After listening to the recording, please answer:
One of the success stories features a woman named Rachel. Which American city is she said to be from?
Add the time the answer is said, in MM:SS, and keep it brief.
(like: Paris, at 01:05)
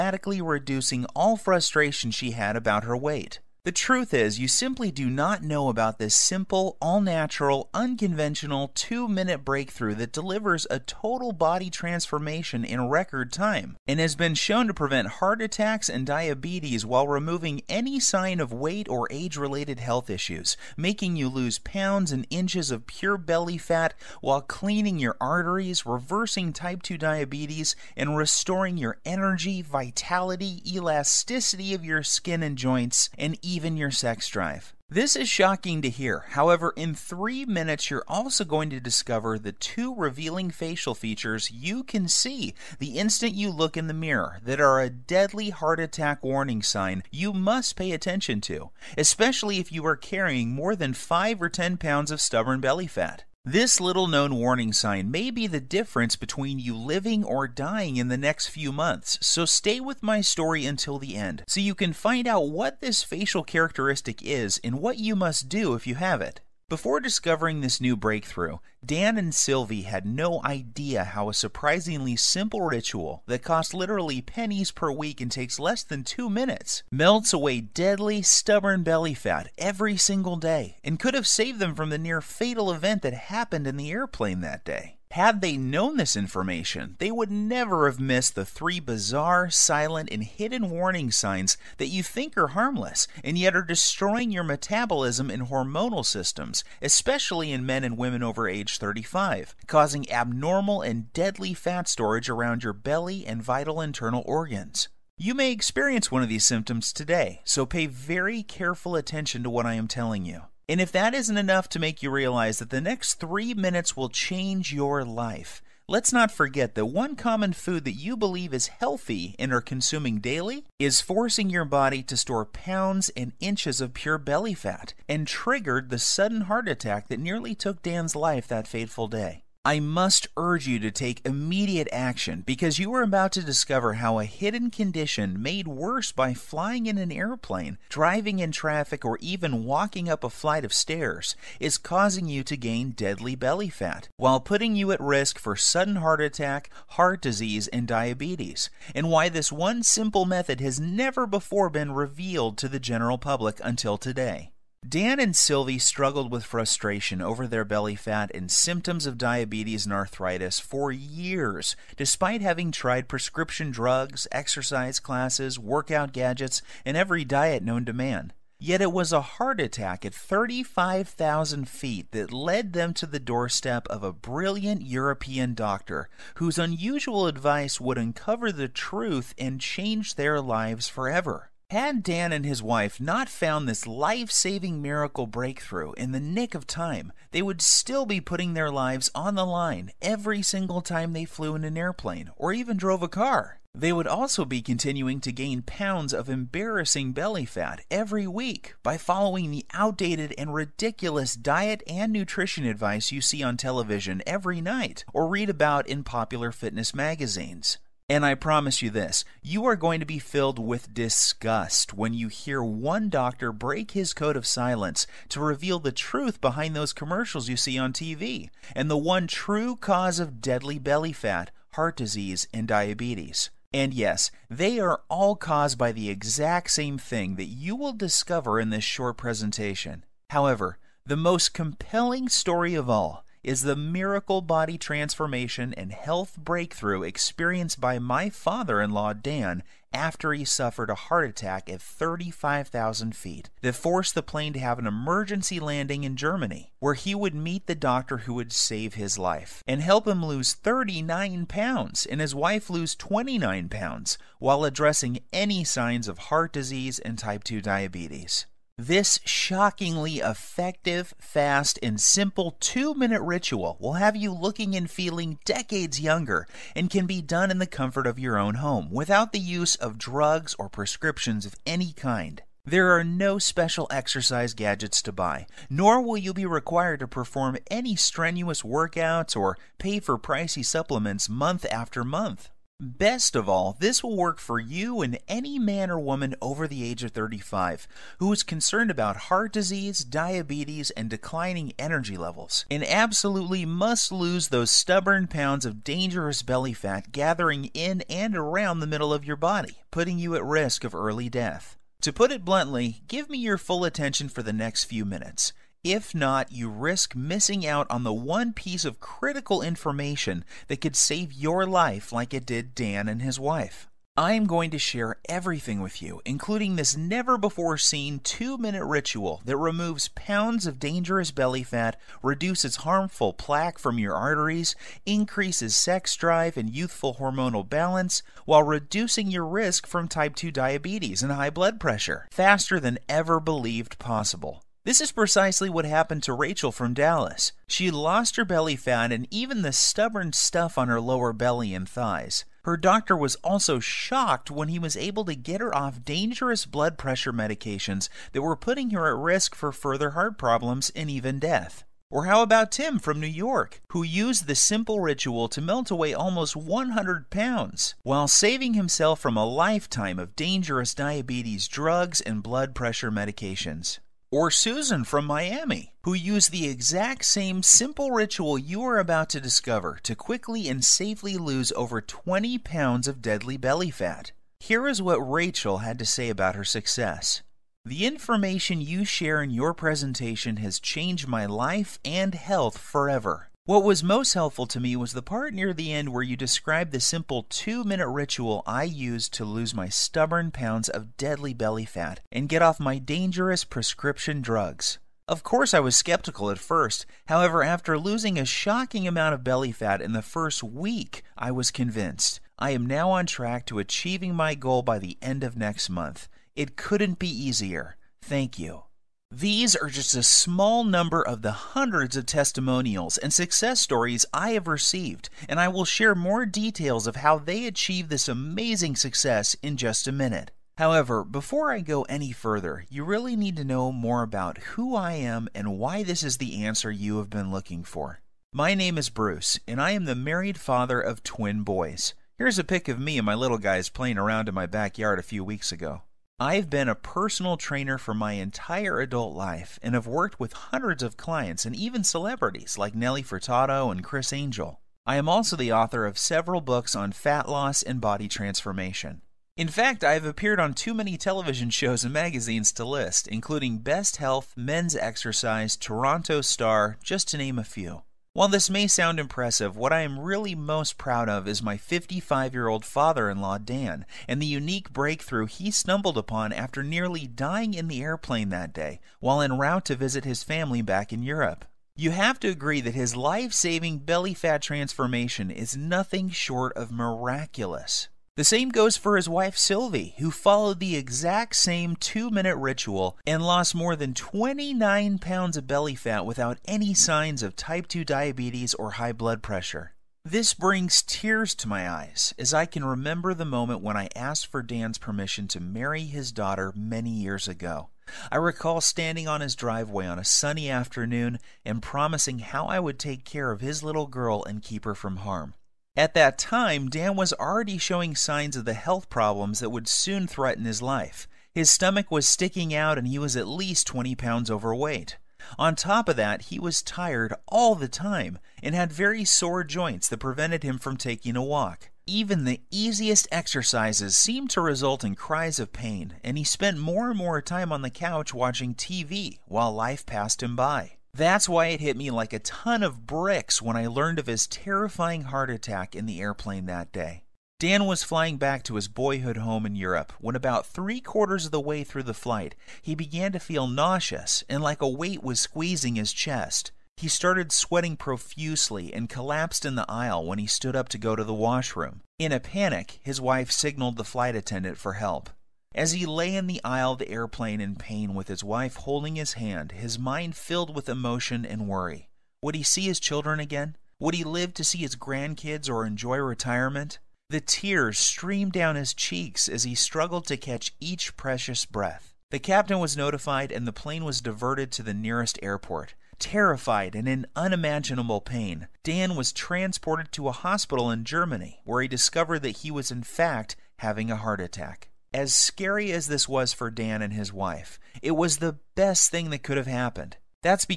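Dallas, at 05:36.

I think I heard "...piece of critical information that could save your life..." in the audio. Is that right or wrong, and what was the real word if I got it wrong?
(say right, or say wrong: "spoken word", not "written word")
right.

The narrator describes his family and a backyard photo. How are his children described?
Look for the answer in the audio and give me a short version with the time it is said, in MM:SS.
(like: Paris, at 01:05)
Twin boys, at 07:11.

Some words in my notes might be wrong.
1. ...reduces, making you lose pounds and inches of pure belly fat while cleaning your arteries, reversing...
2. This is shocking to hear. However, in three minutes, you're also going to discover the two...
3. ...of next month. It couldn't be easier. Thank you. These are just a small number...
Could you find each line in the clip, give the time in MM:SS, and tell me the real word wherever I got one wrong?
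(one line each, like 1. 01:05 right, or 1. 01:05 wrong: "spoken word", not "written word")
1. 00:20 wrong: "issues", not "reduces"
2. 00:34 right
3. 06:45 right.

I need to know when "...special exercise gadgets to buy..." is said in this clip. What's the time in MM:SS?
04:33.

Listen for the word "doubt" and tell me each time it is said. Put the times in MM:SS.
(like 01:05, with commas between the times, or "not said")
not said.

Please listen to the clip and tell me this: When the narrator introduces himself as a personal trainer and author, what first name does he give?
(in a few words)
Bruce.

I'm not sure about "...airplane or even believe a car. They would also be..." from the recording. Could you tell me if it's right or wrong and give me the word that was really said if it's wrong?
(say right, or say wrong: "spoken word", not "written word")
wrong: "drove", not "believe".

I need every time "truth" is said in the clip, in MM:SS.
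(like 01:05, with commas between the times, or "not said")
00:03, 02:58, 03:35.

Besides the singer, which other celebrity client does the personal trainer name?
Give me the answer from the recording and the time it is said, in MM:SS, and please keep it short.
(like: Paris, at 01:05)
Criss Angel, at 07:24.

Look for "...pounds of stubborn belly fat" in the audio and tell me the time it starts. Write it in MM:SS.
00:51.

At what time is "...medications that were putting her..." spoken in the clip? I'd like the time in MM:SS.
05:47.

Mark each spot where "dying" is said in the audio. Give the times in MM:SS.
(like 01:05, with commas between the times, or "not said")
00:57, 07:47.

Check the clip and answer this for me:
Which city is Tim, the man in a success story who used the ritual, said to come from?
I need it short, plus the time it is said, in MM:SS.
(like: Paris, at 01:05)
New York, at 05:53.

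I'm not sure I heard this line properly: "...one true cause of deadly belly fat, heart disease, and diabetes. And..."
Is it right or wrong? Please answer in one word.
right.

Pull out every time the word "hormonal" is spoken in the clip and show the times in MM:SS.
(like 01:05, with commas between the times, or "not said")
01:35, 05:27.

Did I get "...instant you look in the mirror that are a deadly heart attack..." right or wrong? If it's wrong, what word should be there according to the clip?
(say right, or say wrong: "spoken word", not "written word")
right.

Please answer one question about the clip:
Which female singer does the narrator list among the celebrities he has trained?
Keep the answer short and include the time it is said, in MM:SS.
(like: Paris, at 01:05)
Nelly Furtado, at 07:22.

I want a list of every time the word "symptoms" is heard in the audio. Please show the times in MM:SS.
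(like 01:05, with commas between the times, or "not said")
01:46, 02:38.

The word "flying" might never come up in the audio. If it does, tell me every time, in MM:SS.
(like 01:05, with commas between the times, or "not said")
02:16, 08:58.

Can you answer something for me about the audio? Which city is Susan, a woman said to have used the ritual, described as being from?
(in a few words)
Miami.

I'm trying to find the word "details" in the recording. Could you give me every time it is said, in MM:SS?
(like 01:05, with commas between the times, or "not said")
06:56.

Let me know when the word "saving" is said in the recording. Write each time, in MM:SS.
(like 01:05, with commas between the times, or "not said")
03:04, 05:58, 07:53.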